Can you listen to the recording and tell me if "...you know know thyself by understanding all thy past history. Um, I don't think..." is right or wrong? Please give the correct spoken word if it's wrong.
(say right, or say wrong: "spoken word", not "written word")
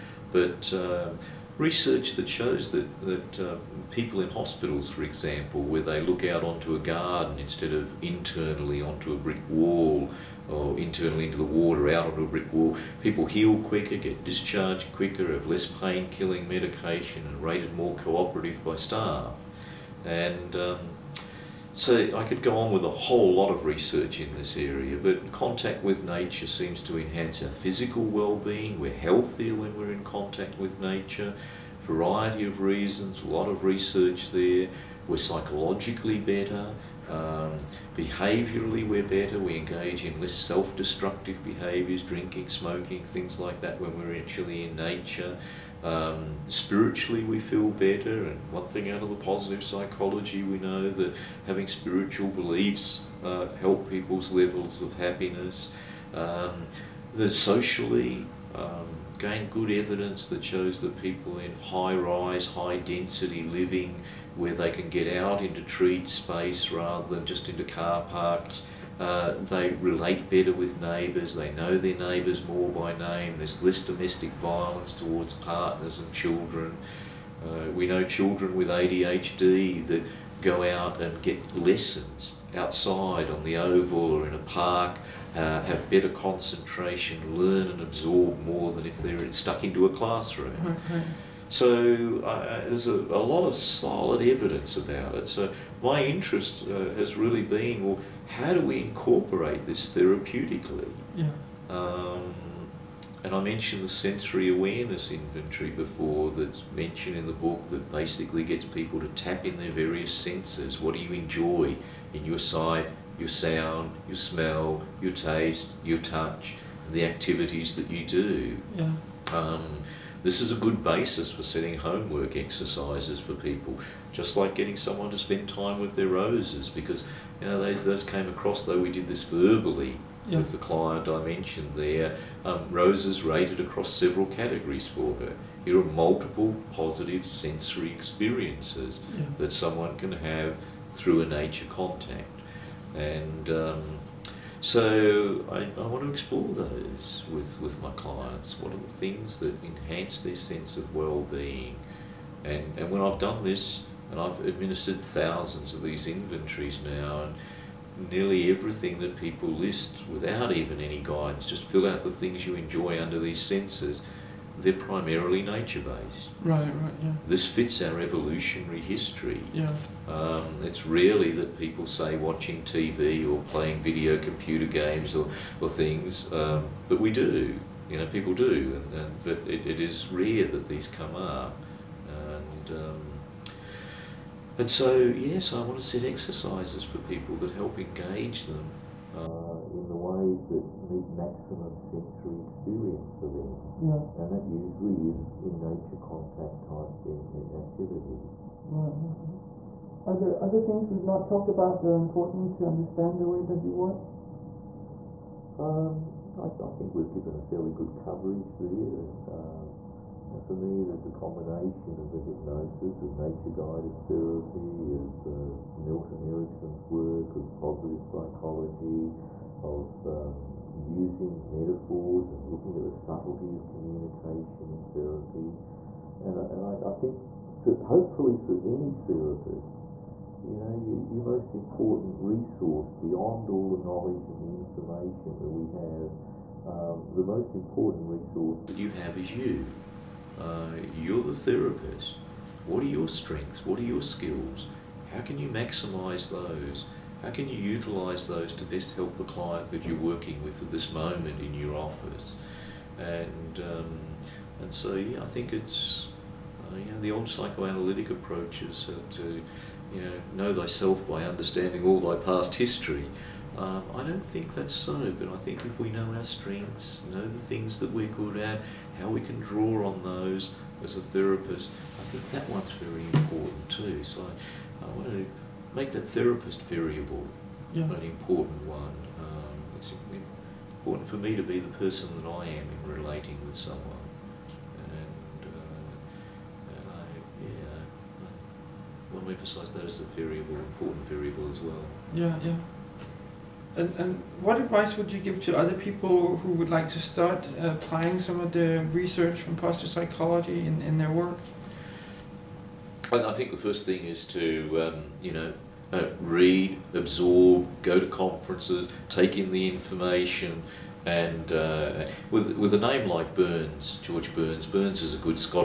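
right.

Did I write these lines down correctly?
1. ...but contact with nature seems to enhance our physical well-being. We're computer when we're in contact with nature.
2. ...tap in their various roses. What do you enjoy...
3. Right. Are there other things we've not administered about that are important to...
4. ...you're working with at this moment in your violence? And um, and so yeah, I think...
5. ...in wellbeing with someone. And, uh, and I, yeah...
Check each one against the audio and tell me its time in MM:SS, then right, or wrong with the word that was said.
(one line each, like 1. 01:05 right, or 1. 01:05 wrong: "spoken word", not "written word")
1. 00:24 wrong: "healthier", not "computer"
2. 01:49 wrong: "senses", not "roses"
3. 03:18 wrong: "talked", not "administered"
4. 04:09 wrong: "office", not "violence"
5. 04:42 wrong: "relating", not "wellbeing".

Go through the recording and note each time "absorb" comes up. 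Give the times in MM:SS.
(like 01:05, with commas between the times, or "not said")
01:27, 05:06.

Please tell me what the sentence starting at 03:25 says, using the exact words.
Um, I, th I think we've given a fairly good coverage there.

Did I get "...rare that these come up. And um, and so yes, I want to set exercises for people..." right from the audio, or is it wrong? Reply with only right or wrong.
right.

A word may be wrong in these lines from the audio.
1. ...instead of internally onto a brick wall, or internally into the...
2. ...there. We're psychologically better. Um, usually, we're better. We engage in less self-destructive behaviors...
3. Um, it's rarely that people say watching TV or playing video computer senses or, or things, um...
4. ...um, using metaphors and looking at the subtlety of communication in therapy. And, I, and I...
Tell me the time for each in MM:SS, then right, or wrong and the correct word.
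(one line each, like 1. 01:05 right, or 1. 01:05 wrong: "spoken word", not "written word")
1. 00:07 right
2. 00:34 wrong: "behaviorally", not "usually"
3. 02:50 wrong: "games", not "senses"
4. 03:40 right.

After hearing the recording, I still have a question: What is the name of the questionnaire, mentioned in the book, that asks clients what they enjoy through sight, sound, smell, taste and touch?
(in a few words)
sensory awareness inventory.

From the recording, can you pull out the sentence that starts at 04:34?
So I want to make that therapist variable yeah.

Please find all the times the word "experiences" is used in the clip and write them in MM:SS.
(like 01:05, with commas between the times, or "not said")
02:17, 03:12.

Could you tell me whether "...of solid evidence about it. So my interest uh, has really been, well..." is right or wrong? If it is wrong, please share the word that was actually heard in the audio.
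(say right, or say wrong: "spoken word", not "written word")
right.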